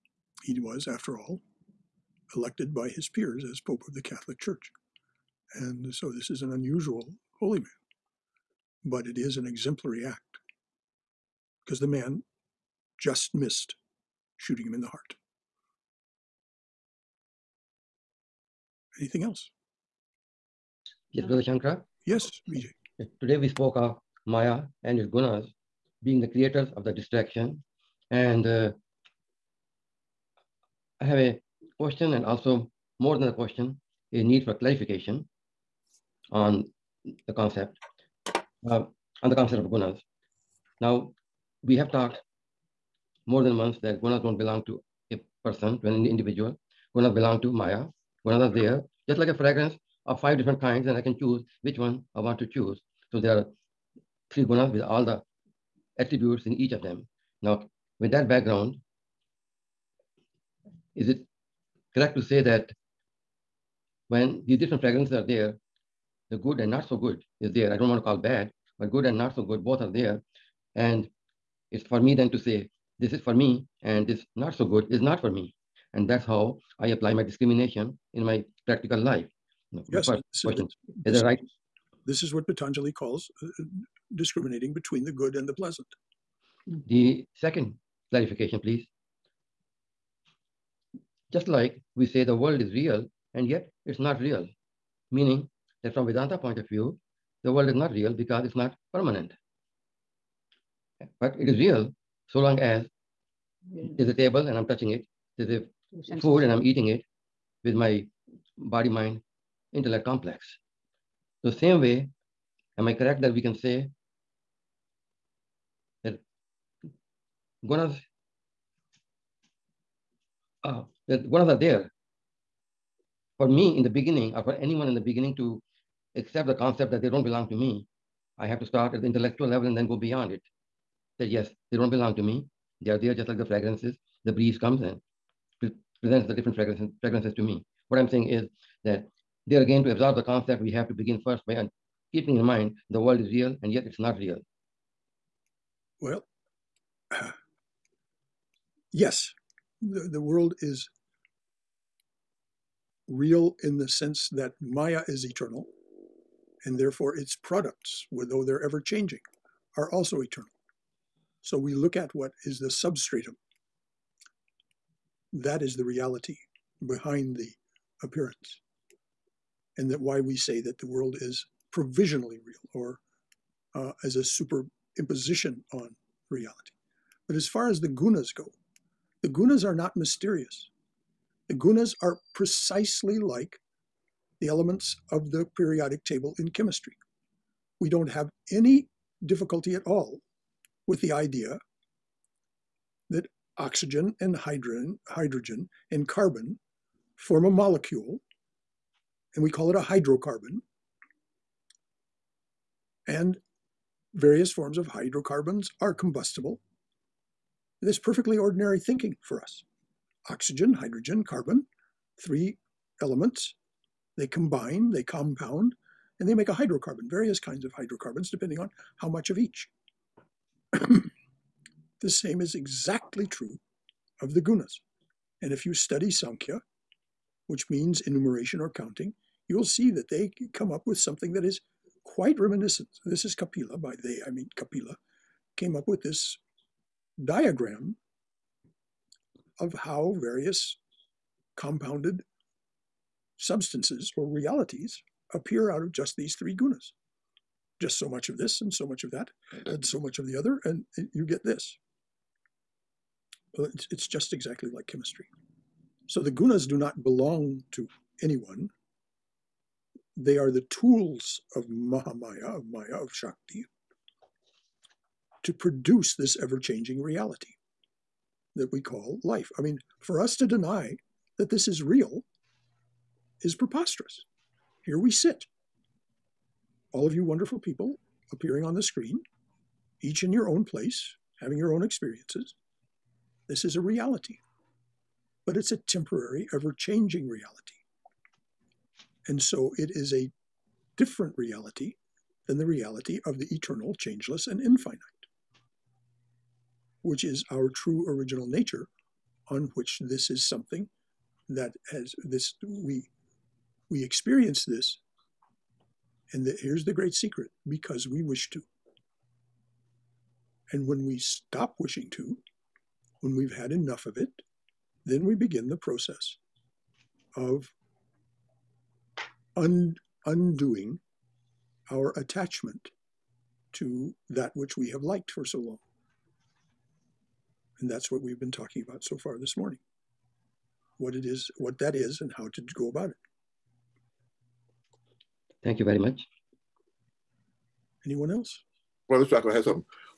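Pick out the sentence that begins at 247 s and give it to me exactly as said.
Just so much of this and so much of that and so much of the other, and you get this.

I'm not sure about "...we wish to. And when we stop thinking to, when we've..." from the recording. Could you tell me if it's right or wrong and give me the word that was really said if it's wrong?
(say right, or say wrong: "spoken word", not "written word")
wrong: "wishing", not "thinking".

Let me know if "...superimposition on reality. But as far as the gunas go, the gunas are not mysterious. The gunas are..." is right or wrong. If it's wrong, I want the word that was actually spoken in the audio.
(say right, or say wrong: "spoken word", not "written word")
right.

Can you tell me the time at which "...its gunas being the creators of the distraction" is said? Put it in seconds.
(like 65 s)
24 s.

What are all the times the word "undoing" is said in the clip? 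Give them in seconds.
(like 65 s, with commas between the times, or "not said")
320 s.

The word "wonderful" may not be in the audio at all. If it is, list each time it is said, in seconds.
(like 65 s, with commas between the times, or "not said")
277 s.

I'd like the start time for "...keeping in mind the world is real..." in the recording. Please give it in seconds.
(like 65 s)
142 s.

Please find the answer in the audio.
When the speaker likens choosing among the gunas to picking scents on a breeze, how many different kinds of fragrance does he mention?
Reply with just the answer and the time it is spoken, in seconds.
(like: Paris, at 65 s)
5, at 50 s.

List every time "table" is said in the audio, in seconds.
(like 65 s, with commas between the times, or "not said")
104 s, 186 s.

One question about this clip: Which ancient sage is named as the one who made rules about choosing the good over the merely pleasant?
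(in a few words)
Patanjali.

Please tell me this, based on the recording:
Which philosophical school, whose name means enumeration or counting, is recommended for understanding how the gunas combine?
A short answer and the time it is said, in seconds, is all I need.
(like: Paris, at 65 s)
Sankhya, at 226 s.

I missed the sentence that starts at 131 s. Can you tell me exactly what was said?
That yes, they don't belong to me.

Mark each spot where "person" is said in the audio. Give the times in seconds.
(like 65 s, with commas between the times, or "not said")
45 s.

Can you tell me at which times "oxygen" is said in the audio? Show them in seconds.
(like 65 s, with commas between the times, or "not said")
193 s, 210 s.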